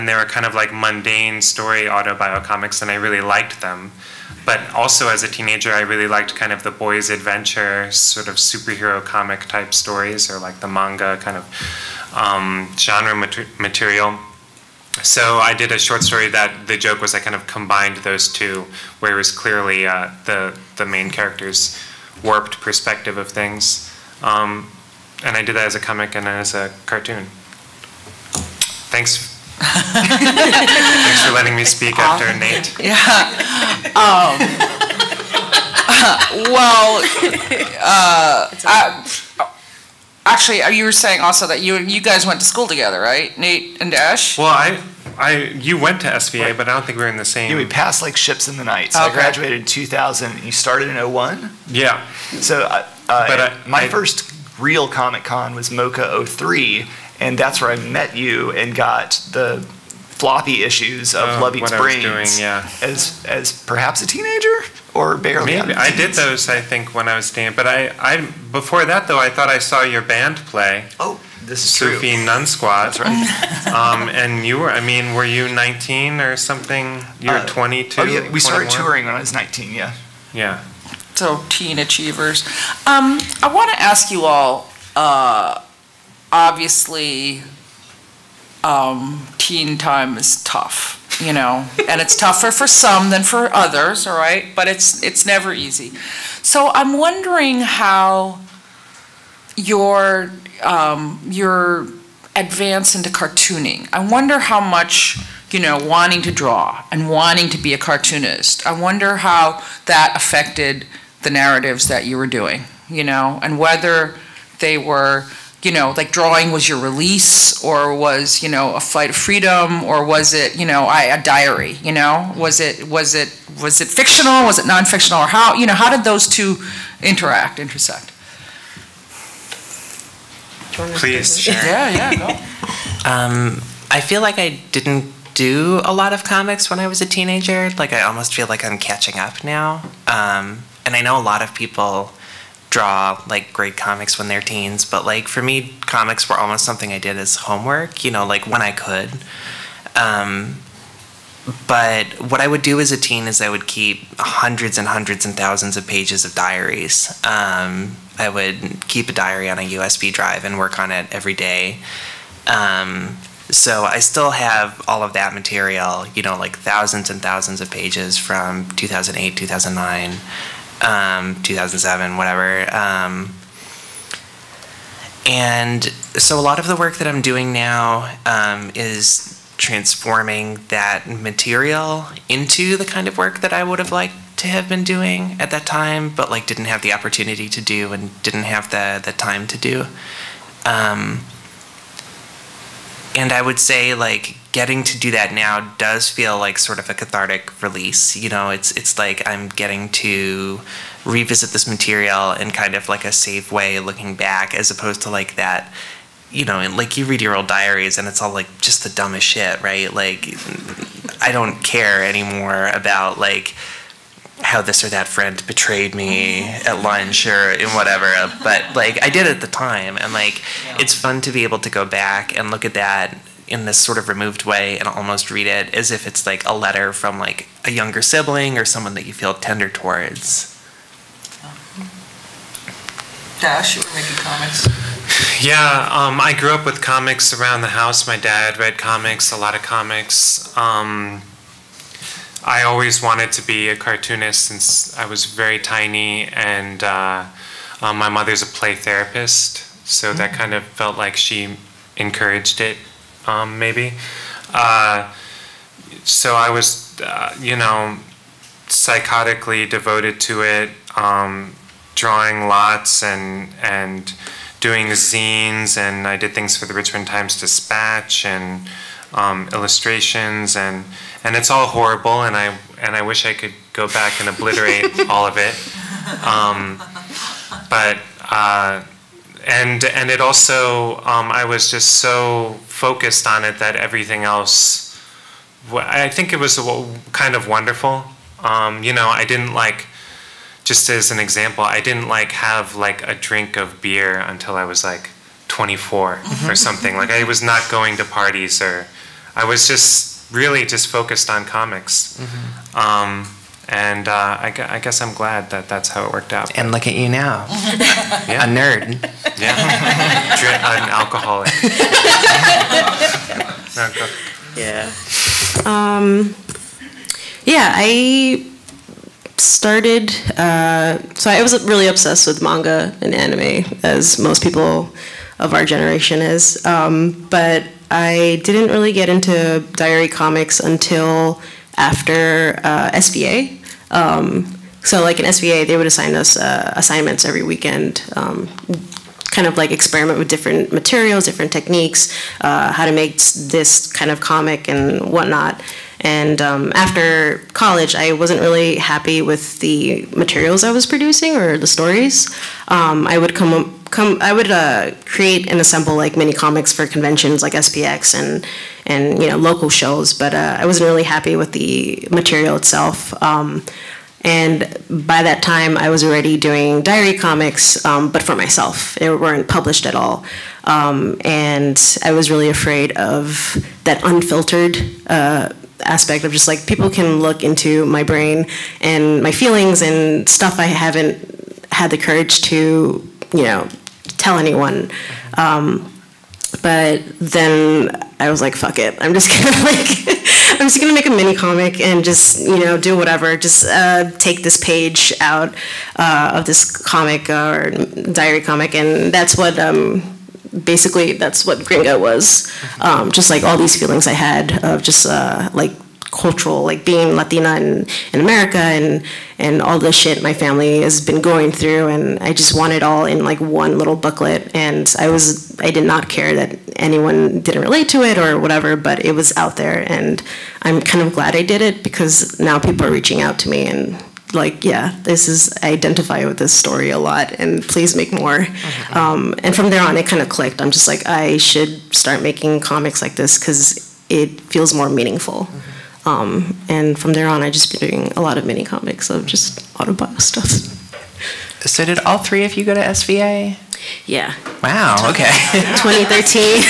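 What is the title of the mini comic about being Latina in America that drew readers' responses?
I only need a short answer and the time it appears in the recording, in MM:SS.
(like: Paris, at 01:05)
Gringa, at 06:41.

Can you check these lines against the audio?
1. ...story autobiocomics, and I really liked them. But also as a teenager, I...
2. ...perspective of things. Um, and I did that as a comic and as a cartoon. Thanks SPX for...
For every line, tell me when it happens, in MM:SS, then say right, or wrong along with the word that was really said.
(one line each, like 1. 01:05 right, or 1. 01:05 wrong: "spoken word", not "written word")
1. 00:01 right
2. 00:22 wrong: "Thanks", not "SPX".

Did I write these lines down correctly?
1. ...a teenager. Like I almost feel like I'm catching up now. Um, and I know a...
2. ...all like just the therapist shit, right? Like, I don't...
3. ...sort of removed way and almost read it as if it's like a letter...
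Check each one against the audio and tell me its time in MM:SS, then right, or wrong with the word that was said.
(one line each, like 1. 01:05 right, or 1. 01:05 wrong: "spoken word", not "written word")
1. 02:17 right
2. 03:28 wrong: "dumbest", not "therapist"
3. 03:43 right.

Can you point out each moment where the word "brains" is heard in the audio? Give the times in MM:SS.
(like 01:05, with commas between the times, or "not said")
01:01, 06:18.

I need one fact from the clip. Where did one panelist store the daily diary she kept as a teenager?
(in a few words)
USB drive.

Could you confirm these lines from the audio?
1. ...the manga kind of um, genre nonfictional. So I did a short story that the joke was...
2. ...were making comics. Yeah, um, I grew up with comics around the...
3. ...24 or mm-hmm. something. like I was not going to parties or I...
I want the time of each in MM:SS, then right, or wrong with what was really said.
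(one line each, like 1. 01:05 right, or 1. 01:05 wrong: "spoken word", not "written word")
1. 00:10 wrong: "material", not "nonfictional"
2. 03:53 right
3. 04:55 right.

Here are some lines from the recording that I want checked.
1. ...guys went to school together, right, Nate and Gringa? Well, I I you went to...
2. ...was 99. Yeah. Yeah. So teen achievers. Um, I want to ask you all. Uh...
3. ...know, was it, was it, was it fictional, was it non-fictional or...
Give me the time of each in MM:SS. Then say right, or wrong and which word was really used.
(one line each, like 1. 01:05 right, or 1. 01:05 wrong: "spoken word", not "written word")
1. 00:41 wrong: "Dash", not "Gringa"
2. 01:19 wrong: "19", not "99"
3. 02:01 right.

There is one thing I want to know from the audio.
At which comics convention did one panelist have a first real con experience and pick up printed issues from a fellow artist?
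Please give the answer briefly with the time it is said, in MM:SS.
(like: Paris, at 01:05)
MoCCA 03, at 00:55.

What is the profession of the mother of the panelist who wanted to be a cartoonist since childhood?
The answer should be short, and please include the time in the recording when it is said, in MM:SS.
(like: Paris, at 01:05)
Play therapist, at 04:08.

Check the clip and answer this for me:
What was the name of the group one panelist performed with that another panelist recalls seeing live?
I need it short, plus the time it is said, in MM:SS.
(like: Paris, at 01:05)
Nun Squad, at 01:12.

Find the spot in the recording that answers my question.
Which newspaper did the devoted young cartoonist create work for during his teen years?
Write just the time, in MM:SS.
04:26.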